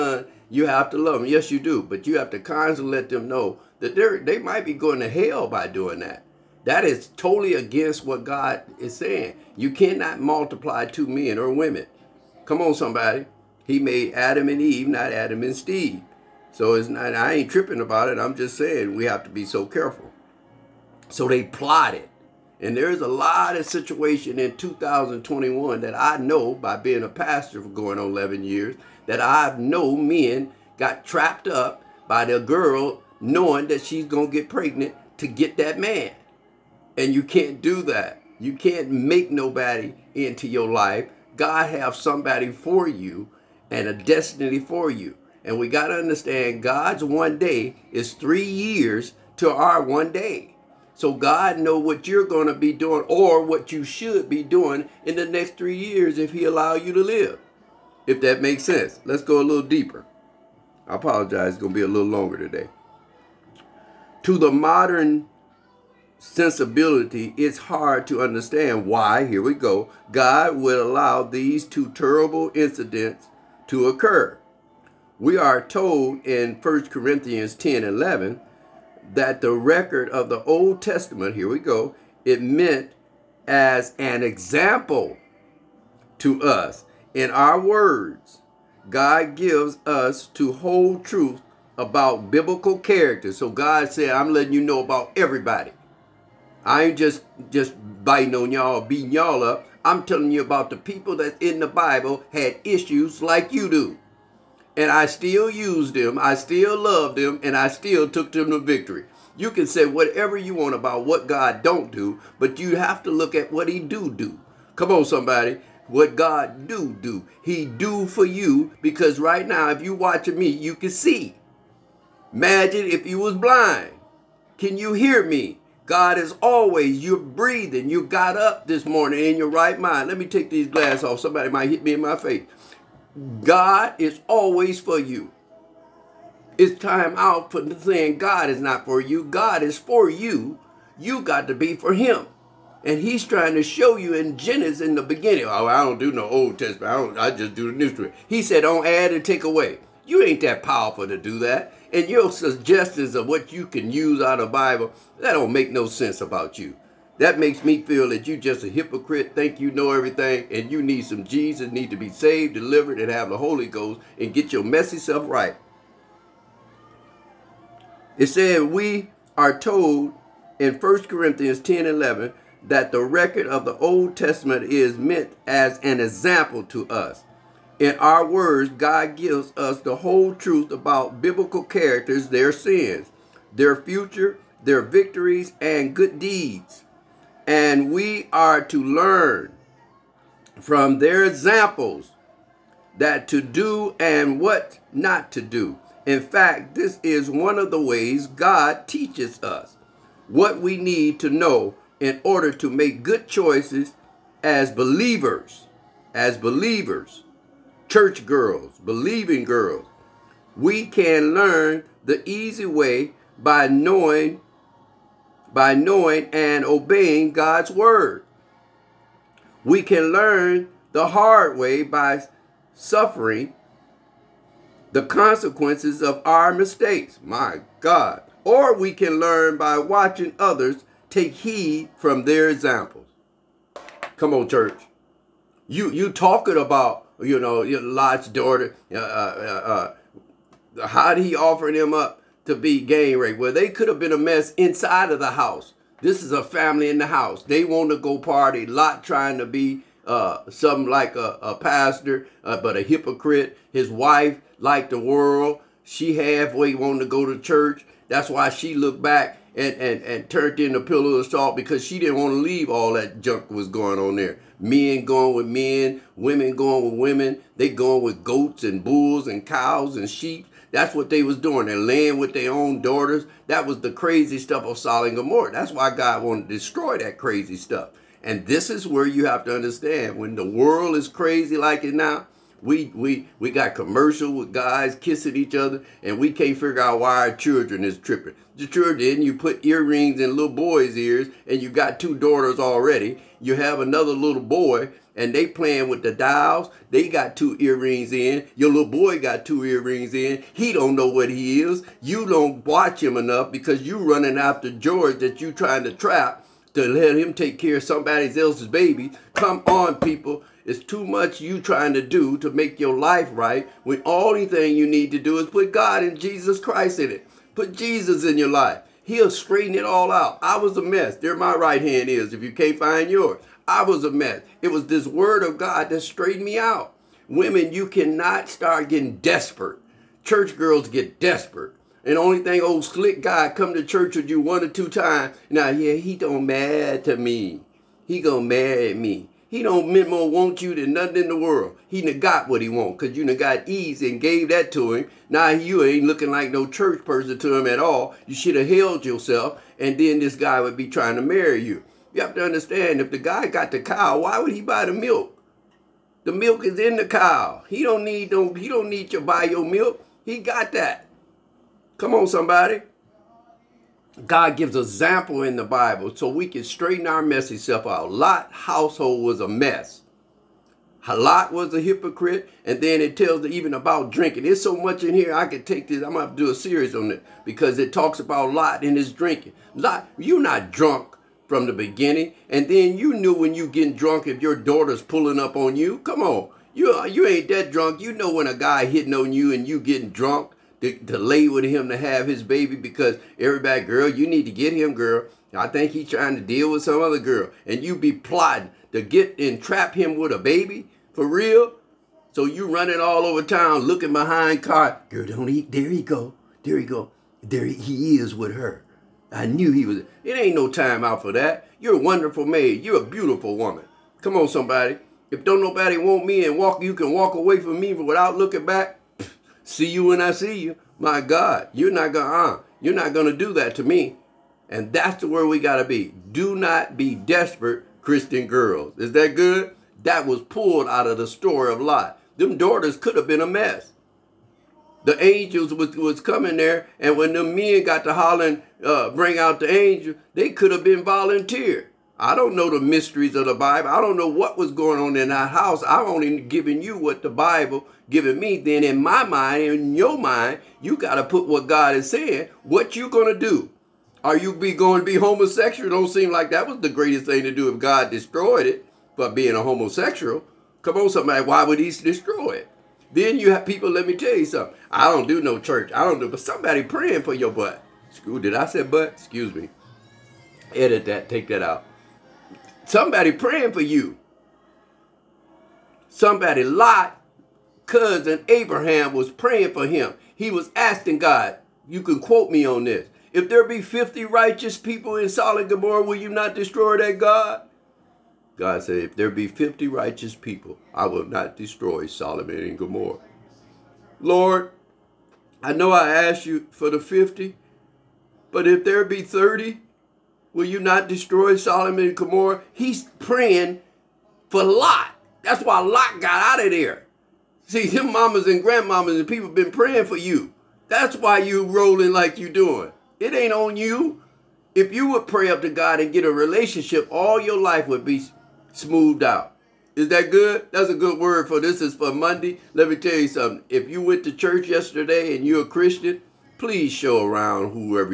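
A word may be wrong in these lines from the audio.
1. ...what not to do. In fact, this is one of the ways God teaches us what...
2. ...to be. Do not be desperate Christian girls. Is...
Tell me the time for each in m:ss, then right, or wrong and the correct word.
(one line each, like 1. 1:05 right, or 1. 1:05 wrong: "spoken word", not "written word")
1. 3:14 right
2. 7:05 right.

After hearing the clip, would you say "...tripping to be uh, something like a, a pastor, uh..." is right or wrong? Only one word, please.
wrong.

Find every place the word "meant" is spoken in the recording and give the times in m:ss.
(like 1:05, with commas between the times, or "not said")
1:22, 2:54, 5:39.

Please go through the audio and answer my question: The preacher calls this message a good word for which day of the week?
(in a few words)
Monday.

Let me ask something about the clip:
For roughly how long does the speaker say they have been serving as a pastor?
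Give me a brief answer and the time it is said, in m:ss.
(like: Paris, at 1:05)
11 years, at 0:28.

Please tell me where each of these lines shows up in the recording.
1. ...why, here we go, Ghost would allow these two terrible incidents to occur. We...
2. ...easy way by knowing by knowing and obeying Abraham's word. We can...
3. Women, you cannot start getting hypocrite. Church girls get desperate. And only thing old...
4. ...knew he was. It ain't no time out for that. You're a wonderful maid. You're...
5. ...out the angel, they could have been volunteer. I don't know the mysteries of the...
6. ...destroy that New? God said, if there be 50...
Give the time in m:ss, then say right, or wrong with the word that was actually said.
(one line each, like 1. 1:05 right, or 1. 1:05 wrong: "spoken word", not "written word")
1. 1:08 wrong: "God", not "Ghost"
2. 3:32 wrong: "God", not "Abraham"
3. 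5:27 wrong: "desperate", not "hypocrite"
4. 6:49 right
5. 7:19 right
6. 8:06 wrong: "God", not "New".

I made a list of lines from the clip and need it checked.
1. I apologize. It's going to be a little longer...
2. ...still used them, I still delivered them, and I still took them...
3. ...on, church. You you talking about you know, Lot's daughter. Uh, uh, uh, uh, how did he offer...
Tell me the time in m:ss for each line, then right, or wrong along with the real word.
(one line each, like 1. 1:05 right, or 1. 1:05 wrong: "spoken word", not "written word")
1. 1:00 right
2. 1:45 wrong: "loved", not "delivered"
3. 3:54 right.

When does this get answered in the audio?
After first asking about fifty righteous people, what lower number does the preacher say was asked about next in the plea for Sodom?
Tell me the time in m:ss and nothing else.
8:19.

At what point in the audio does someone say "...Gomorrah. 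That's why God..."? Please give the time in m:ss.
4:35.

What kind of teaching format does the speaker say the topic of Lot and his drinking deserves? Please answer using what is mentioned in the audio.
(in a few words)
a series.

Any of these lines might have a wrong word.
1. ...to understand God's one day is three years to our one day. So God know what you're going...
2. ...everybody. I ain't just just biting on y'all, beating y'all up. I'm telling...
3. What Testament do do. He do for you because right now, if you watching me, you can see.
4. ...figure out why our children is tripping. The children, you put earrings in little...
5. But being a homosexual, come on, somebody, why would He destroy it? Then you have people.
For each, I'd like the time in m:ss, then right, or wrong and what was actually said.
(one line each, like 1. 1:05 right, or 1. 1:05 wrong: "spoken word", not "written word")
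1. 0:45 right
2. 1:35 right
3. 1:55 wrong: "God", not "Testament"
4. 4:46 right
5. 7:39 right.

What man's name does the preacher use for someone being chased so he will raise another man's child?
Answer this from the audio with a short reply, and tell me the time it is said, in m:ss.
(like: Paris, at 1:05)
George, at 5:04.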